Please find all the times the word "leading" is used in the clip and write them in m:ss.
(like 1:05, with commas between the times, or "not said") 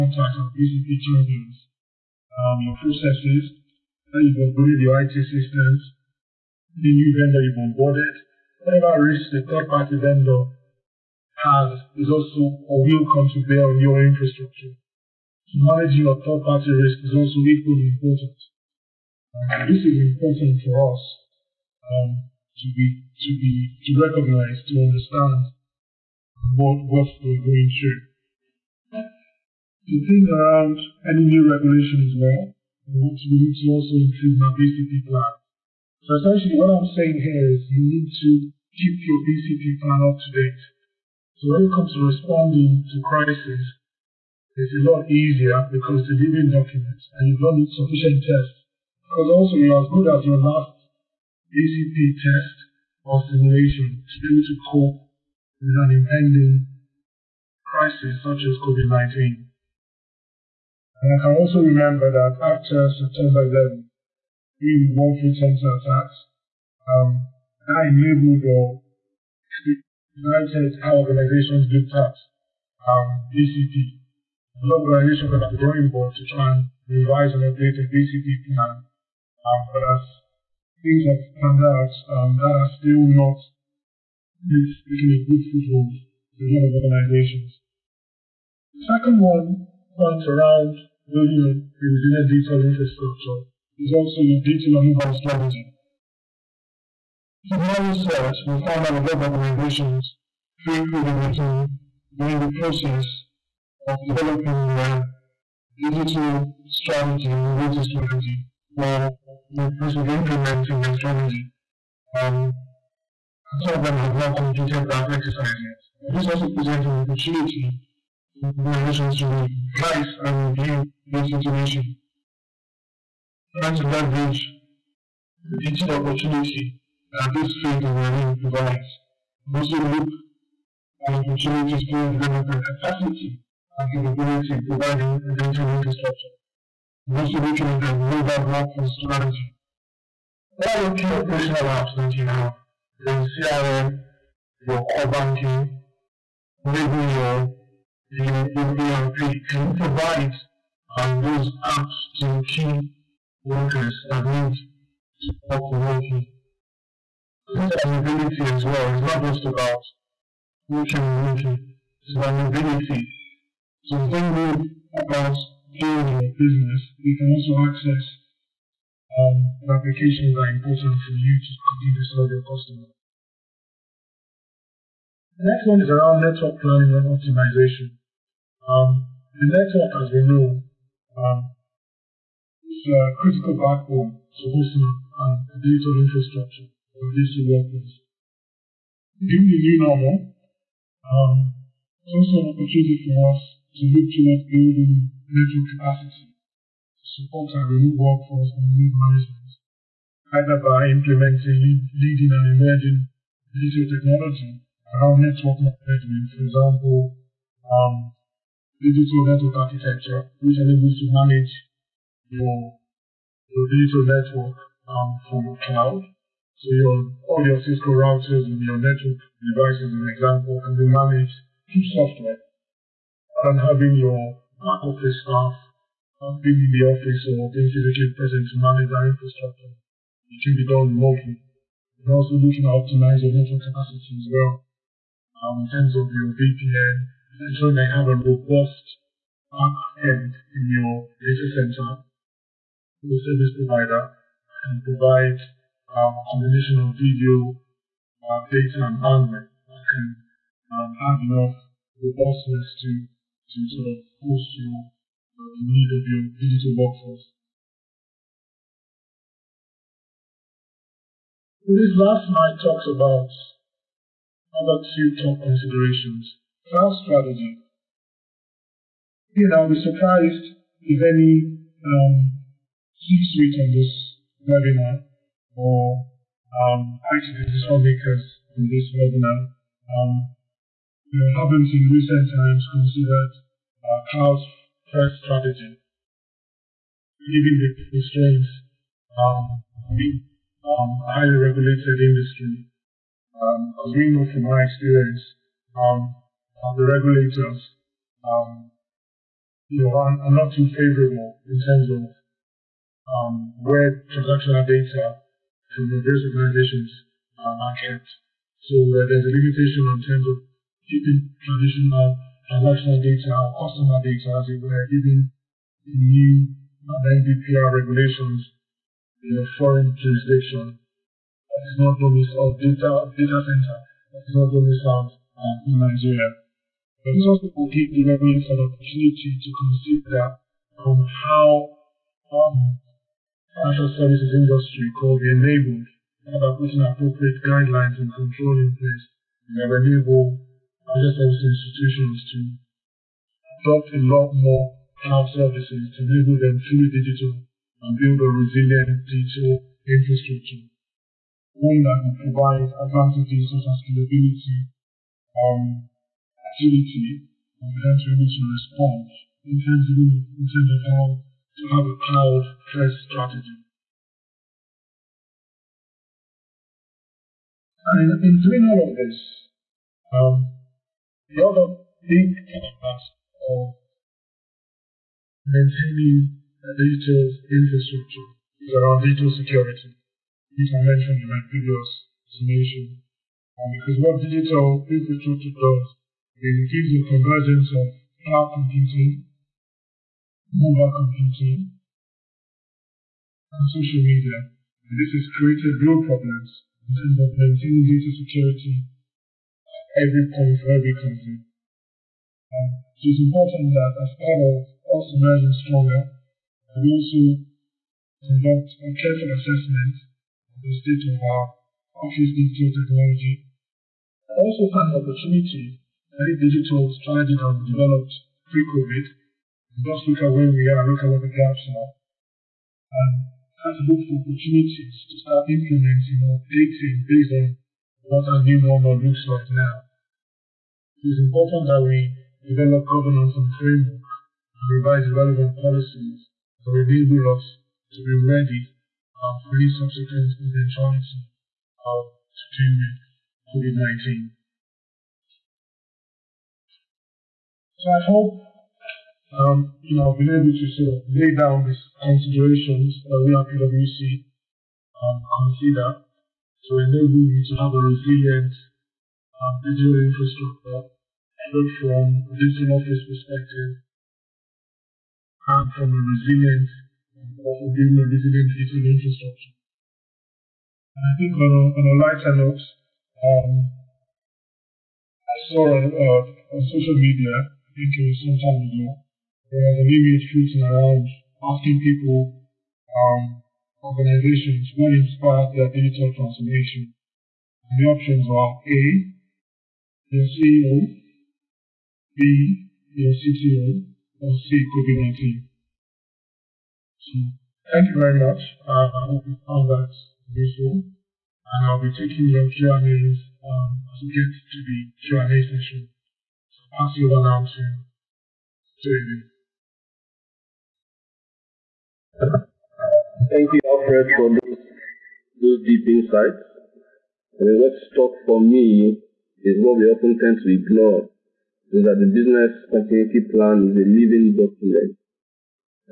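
3:21.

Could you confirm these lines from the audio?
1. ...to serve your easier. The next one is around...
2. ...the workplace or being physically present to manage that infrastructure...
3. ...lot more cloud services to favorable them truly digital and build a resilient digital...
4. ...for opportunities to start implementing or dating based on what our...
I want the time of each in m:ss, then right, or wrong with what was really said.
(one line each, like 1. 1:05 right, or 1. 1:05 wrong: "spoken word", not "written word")
1. 2:51 wrong: "customer", not "easier"
2. 3:46 wrong: "office", not "workplace"
3. 5:44 wrong: "enable", not "favorable"
4. 7:04 right.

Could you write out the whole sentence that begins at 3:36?
So your, all your Cisco routers and your network devices, an example, can be managed through software.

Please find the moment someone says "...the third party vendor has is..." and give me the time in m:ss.
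0:09.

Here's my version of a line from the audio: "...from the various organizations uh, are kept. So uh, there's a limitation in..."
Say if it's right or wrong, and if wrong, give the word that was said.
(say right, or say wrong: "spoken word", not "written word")
right.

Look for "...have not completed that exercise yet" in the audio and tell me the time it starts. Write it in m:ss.
1:53.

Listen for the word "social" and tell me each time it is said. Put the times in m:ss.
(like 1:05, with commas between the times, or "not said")
6:33, 7:56.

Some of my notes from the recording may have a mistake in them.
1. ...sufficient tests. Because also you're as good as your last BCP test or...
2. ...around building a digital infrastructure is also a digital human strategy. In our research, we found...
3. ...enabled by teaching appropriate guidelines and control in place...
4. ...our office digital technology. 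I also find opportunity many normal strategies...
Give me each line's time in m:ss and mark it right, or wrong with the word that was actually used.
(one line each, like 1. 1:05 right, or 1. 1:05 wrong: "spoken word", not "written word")
1. 0:47 right
2. 1:30 right
3. 5:35 wrong: "putting", not "teaching"
4. 6:51 wrong: "digital", not "normal".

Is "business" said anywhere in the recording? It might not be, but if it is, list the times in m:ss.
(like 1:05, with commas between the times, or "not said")
2:46, 8:42.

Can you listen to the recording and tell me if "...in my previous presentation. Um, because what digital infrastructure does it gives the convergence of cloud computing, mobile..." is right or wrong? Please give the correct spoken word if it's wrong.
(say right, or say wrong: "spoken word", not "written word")
right.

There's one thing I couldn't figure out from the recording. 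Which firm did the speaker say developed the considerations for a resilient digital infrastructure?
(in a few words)
PwC.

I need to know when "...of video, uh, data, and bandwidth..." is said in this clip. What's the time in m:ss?
4:06.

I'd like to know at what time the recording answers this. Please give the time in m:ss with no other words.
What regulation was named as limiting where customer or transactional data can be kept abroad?
5:16.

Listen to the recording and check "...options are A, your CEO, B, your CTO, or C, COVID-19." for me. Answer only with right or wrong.
right.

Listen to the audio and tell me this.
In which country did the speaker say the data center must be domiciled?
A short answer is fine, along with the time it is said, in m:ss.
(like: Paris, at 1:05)
Nigeria, at 5:25.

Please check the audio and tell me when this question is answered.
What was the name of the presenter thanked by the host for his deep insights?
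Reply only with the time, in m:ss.
8:33.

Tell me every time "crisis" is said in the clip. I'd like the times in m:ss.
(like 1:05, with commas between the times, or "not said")
0:43, 0:57.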